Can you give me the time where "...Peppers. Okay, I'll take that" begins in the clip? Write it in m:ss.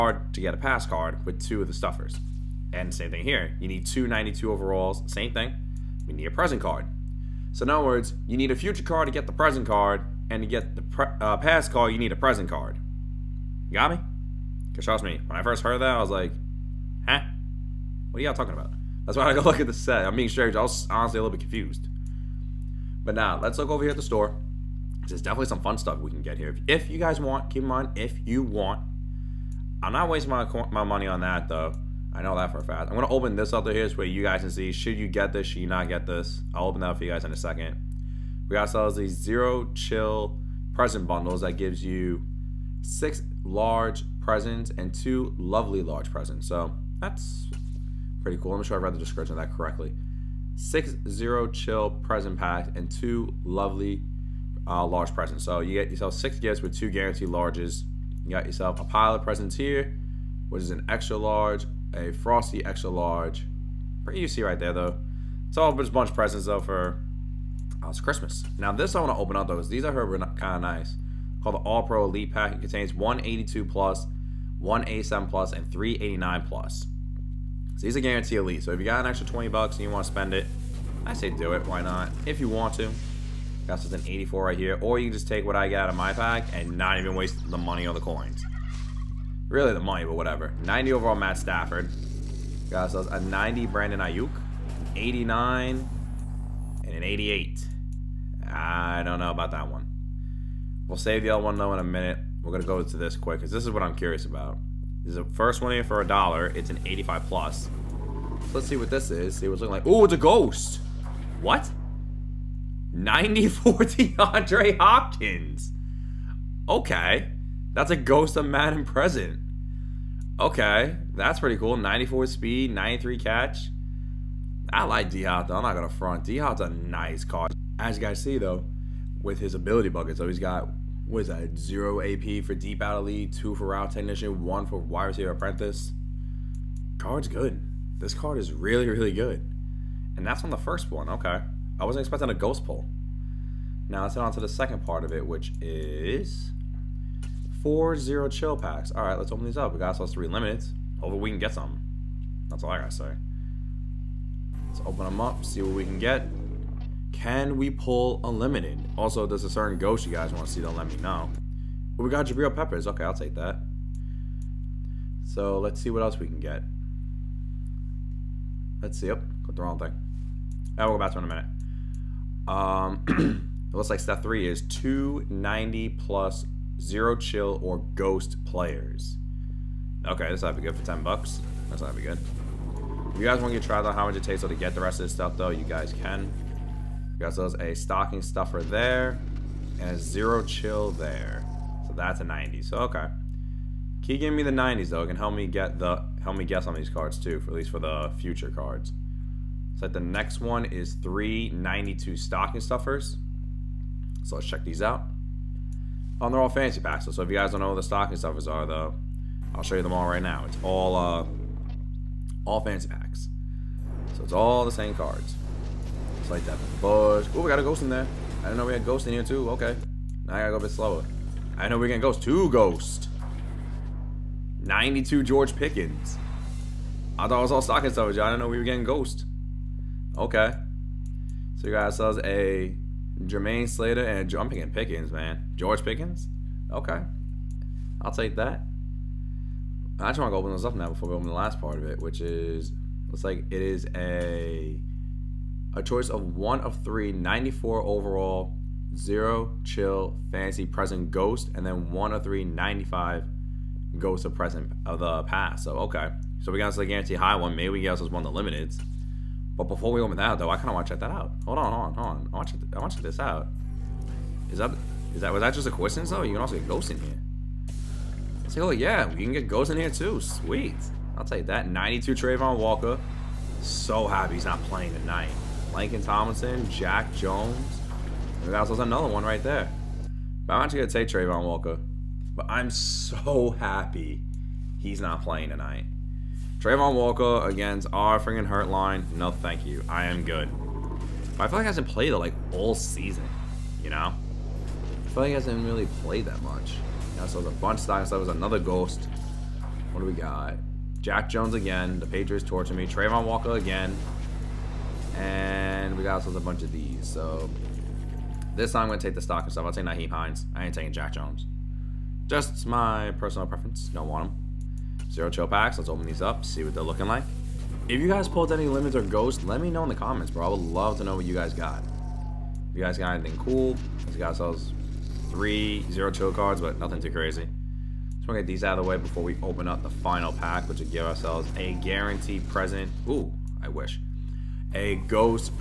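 2:42.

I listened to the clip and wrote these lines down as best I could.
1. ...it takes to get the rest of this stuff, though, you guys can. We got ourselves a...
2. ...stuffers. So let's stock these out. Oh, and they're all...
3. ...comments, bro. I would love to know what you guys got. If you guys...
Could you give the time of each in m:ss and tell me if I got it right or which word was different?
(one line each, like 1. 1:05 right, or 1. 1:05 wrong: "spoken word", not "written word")
1. 3:04 right
2. 3:22 wrong: "check", not "stock"
3. 5:19 right.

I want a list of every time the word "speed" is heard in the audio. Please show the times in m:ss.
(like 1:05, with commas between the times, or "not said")
2:02.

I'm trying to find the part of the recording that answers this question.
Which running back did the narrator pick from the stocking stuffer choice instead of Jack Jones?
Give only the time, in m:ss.
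5:09.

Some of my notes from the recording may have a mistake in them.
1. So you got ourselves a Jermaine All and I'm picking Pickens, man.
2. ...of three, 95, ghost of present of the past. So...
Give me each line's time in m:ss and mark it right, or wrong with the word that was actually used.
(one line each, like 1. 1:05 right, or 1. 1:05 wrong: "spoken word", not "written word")
1. 3:51 wrong: "Slater", not "All"
2. 4:12 right.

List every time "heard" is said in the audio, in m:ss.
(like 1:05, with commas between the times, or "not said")
0:15, 1:09.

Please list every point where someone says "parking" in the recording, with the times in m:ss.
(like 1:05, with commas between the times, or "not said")
not said.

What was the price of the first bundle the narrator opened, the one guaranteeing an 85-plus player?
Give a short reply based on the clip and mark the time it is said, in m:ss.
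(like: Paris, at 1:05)
a dollar, at 1:46.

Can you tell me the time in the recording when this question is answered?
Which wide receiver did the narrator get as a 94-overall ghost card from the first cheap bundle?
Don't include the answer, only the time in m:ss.
1:53.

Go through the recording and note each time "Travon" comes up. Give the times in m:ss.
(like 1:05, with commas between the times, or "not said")
4:32, 4:41, 4:46, 5:02.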